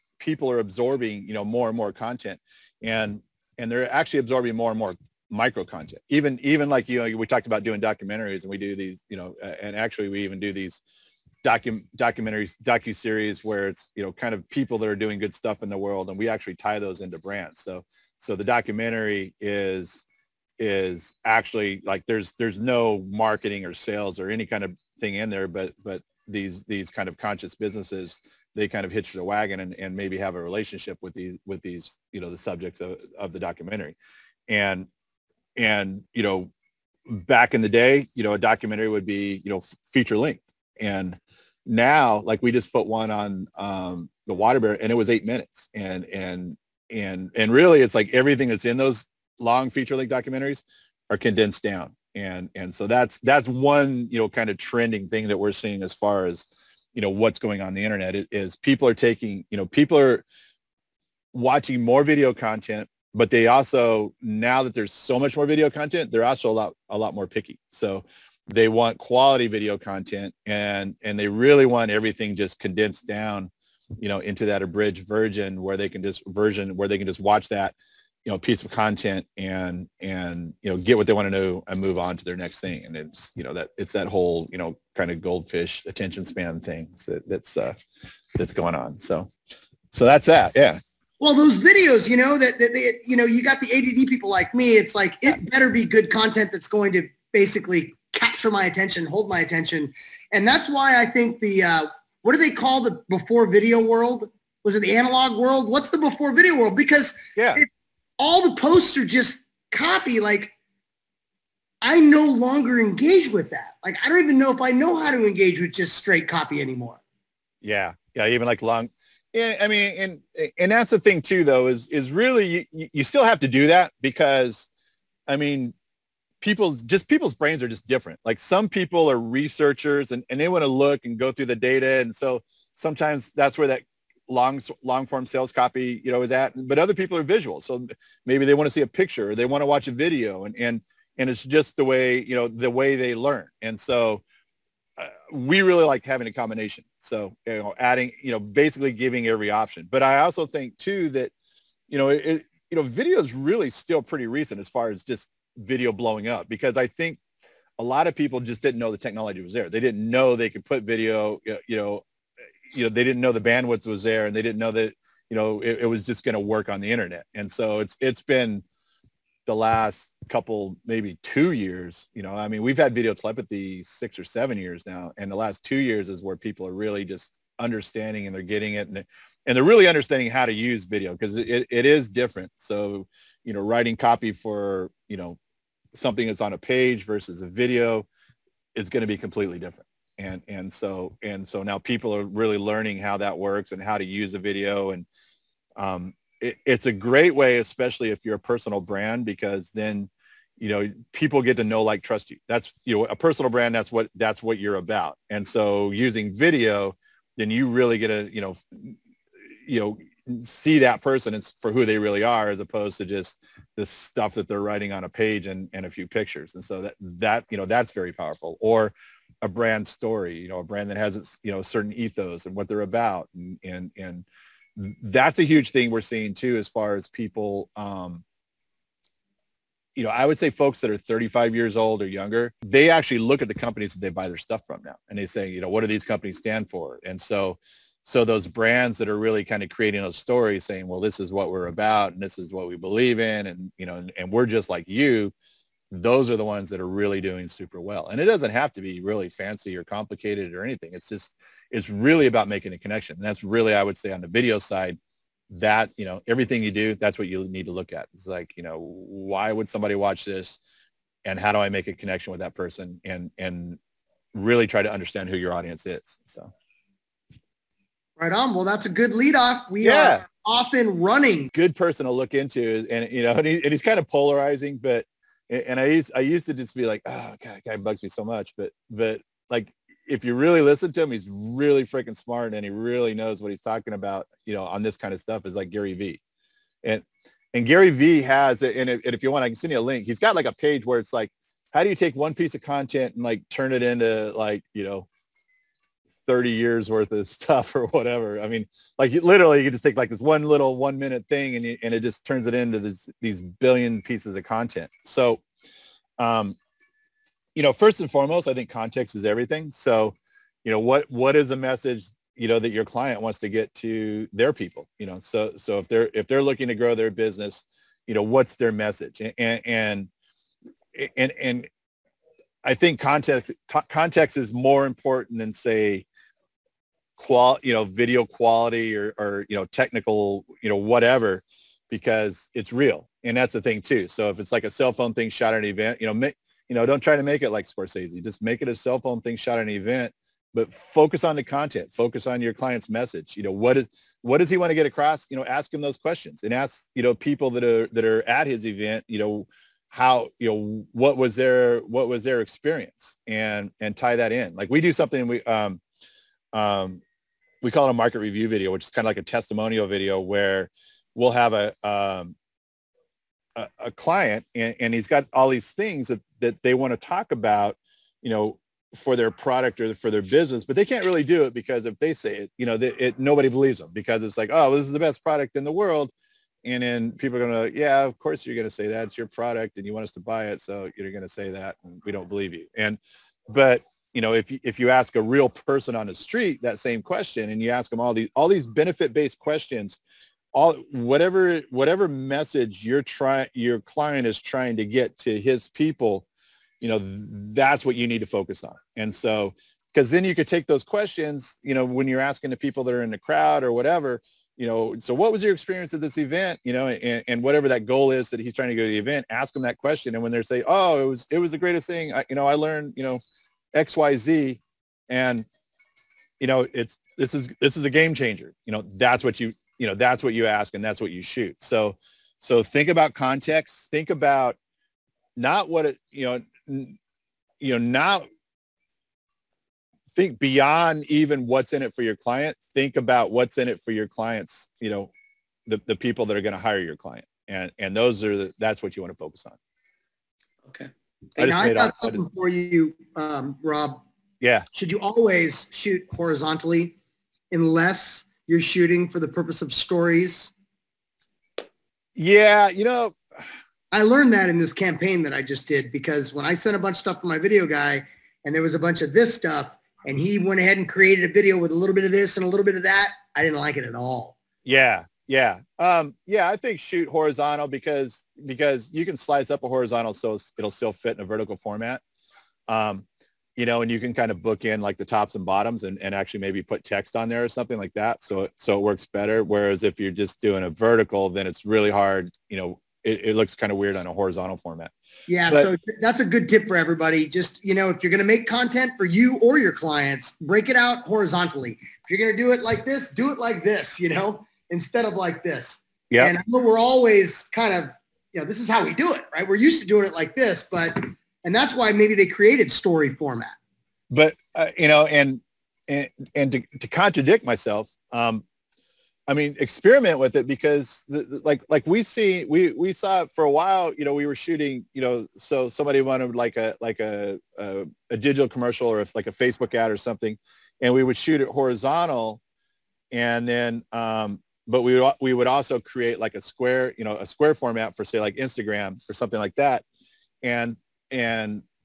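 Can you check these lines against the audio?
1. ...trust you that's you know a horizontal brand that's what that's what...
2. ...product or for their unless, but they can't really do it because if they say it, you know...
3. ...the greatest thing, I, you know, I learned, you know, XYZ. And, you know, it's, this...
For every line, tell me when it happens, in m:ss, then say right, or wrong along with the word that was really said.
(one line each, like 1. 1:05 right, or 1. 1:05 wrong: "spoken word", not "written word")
1. 3:22 wrong: "personal", not "horizontal"
2. 6:09 wrong: "business", not "unless"
3. 6:51 right.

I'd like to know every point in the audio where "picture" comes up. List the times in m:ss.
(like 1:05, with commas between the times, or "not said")
2:18, 3:36.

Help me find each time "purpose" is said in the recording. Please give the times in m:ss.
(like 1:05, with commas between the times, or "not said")
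7:29.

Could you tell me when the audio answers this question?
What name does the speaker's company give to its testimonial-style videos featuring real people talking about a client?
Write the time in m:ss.
5:57.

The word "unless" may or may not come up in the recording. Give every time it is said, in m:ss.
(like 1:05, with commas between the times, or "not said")
7:27.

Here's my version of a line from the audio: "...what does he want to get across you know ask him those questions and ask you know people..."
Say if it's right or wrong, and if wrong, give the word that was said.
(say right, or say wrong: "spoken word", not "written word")
right.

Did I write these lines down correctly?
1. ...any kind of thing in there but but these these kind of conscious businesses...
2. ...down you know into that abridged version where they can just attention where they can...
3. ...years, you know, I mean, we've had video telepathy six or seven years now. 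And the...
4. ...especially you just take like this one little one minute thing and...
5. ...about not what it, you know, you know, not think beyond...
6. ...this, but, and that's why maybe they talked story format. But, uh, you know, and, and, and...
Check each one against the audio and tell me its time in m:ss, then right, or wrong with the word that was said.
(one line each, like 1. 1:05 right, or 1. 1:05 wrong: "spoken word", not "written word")
1. 0:24 right
2. 1:13 wrong: "version", not "attention"
3. 2:51 right
4. 4:59 wrong: "literally", not "especially"
5. 7:04 right
6. 8:20 wrong: "created", not "talked".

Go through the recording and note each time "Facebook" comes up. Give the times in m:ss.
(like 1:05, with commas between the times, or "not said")
8:39.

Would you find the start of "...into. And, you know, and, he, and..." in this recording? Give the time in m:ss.
4:32.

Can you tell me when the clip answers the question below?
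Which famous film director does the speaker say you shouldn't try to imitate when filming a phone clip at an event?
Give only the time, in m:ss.
5:37.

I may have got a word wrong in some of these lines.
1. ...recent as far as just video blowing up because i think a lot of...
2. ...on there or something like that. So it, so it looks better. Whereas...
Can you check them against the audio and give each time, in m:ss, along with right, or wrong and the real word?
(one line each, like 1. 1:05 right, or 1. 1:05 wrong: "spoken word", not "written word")
1. 2:34 right
2. 7:57 wrong: "works", not "looks".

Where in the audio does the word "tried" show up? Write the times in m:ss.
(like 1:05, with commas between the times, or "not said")
not said.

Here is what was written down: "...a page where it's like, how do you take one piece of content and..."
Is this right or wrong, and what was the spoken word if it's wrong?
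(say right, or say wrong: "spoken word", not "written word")
right.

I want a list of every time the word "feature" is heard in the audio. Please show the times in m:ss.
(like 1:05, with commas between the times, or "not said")
0:39, 0:49.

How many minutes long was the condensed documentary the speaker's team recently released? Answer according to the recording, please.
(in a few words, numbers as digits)
8.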